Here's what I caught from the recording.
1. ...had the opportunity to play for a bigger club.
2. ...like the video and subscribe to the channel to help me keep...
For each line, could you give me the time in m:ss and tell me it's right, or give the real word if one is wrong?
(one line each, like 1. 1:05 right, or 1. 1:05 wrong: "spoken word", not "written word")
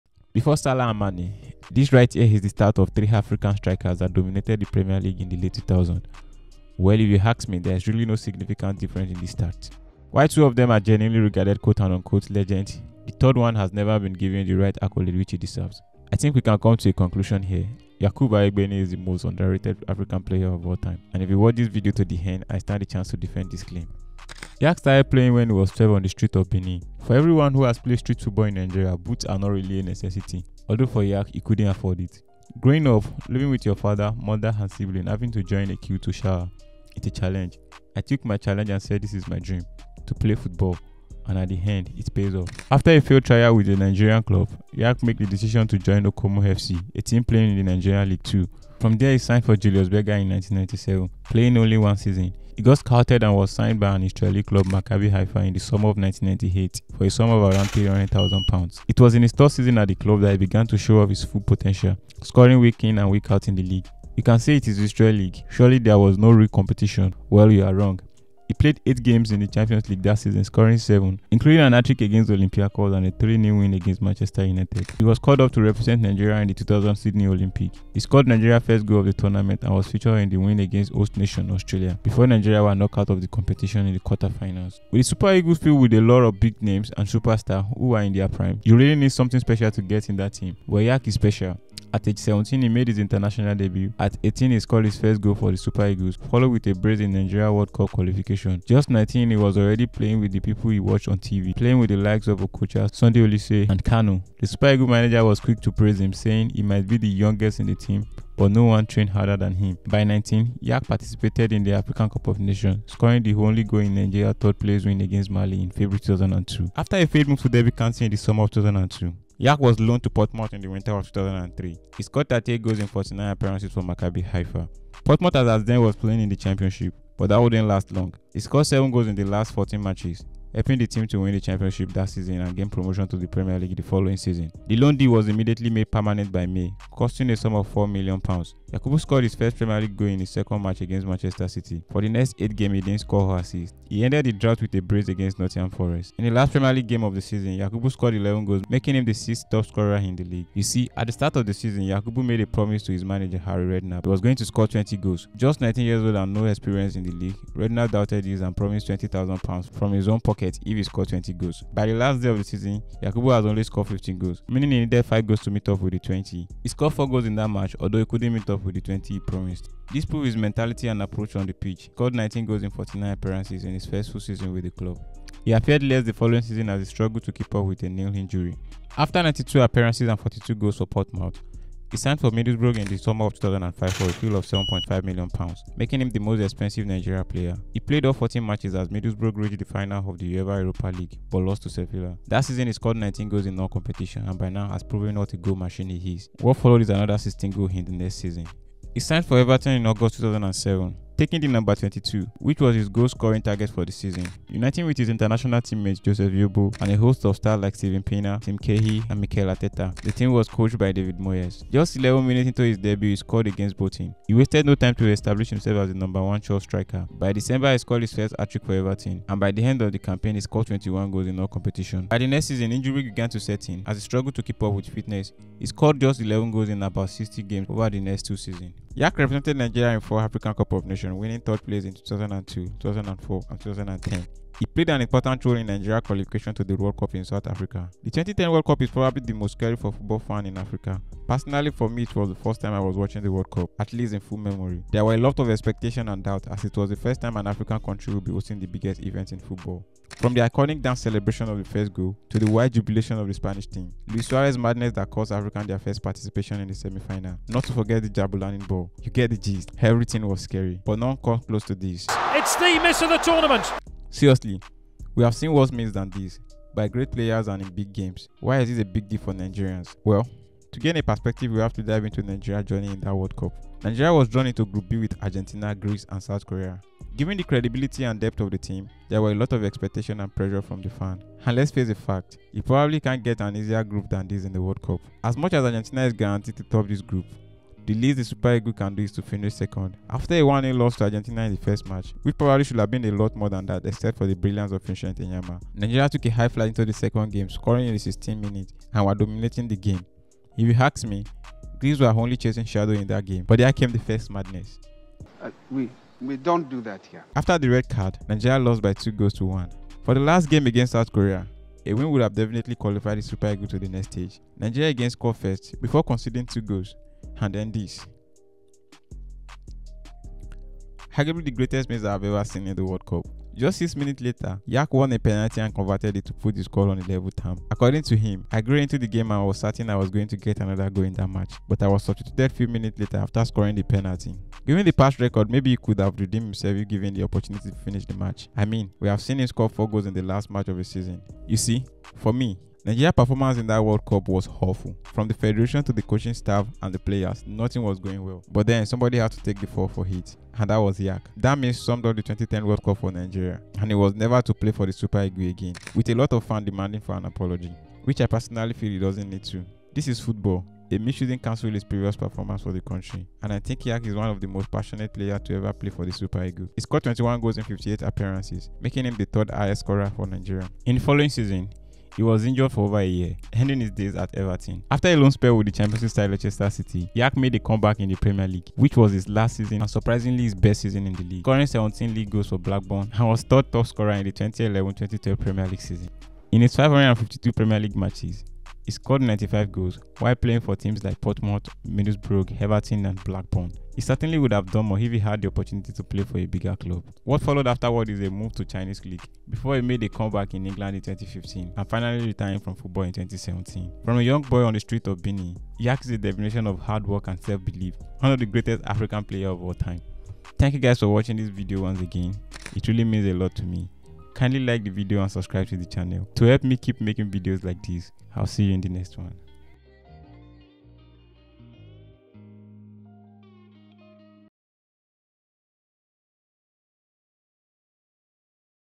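1. 6:35 right
2. 6:54 right.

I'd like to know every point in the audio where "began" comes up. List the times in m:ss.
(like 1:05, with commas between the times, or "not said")
1:00, 3:43.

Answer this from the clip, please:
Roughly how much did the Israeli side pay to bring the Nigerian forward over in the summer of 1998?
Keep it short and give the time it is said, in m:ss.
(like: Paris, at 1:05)
£300,000, at 0:57.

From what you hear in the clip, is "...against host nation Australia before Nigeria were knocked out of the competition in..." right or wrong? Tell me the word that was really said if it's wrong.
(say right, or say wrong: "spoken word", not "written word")
right.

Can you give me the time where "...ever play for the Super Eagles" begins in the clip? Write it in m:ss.
6:05.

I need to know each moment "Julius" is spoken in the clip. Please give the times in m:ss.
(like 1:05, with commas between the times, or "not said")
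0:49.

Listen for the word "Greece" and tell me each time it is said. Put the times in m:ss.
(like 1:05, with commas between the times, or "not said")
4:35, 5:01.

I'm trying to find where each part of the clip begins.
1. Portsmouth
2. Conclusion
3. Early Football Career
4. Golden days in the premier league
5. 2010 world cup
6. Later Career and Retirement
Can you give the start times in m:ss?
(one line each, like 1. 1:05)
1. 1:56
2. 6:44
3. 0:23
4. 2:51
5. 3:48
6. 6:11.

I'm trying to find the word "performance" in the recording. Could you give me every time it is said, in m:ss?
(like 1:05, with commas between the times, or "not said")
5:43, 6:02.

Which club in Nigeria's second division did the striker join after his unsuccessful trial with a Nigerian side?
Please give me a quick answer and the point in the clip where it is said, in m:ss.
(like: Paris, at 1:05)
Okomo FC, at 0:46.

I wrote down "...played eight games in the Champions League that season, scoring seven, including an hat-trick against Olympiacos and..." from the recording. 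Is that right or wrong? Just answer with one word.
right.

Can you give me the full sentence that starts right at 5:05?
Uh, we, we don't do that here.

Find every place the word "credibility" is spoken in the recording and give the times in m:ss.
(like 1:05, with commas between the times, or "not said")
4:37.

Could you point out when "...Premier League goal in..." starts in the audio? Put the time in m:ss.
2:19.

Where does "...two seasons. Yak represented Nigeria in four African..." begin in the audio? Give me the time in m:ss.
3:48.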